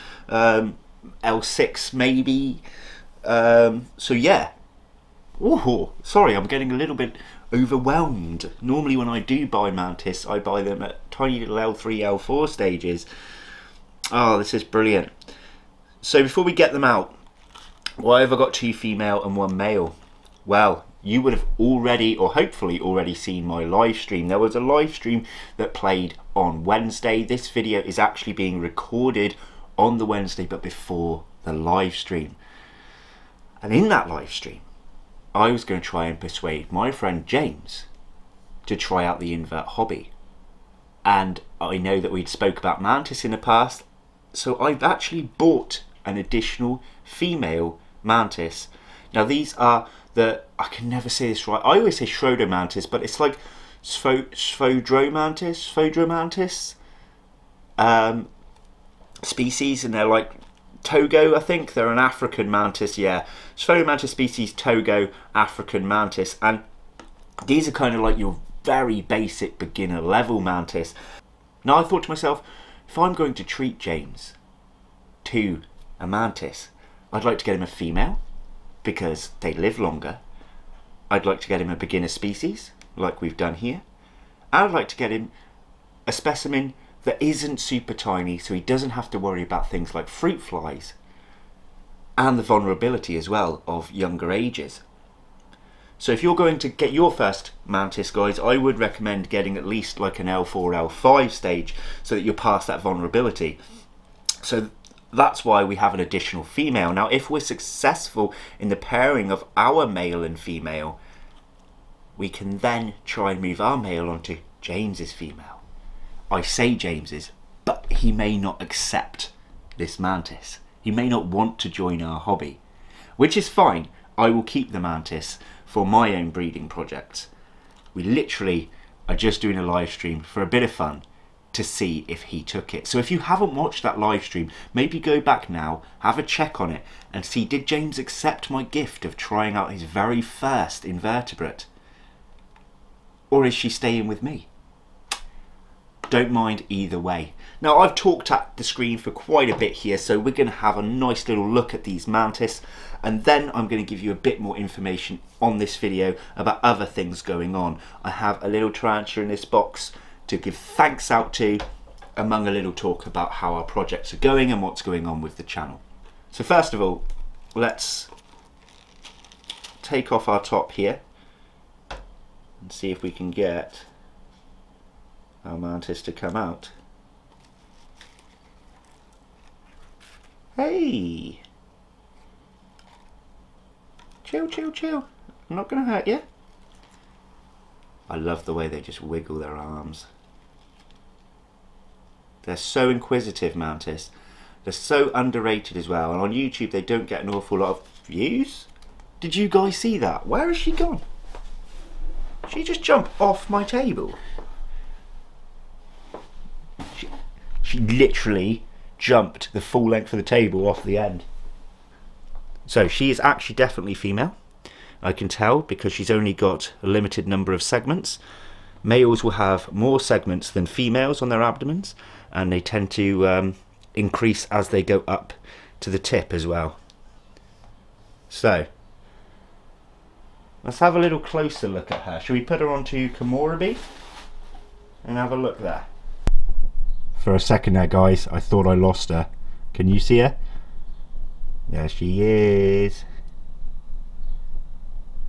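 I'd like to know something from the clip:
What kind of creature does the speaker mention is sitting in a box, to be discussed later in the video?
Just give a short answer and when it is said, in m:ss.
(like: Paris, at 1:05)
tarantula, at 2:38.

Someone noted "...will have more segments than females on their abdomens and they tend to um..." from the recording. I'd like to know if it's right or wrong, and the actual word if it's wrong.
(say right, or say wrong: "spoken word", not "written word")
right.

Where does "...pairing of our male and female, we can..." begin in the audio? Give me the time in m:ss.
1:48.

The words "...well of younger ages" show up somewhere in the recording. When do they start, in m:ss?
1:33.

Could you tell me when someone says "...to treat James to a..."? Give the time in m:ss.
1:13.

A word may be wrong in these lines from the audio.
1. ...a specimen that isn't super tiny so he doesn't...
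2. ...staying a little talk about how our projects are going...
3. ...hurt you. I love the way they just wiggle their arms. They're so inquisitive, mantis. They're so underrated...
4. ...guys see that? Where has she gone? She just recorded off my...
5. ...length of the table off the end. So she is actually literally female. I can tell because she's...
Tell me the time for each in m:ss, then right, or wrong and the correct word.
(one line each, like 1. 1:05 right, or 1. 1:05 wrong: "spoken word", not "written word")
1. 1:26 right
2. 2:42 wrong: "among", not "staying"
3. 3:05 right
4. 3:19 wrong: "jumped", not "recorded"
5. 3:29 wrong: "definitely", not "literally".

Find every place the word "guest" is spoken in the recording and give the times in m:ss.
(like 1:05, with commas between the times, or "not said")
not said.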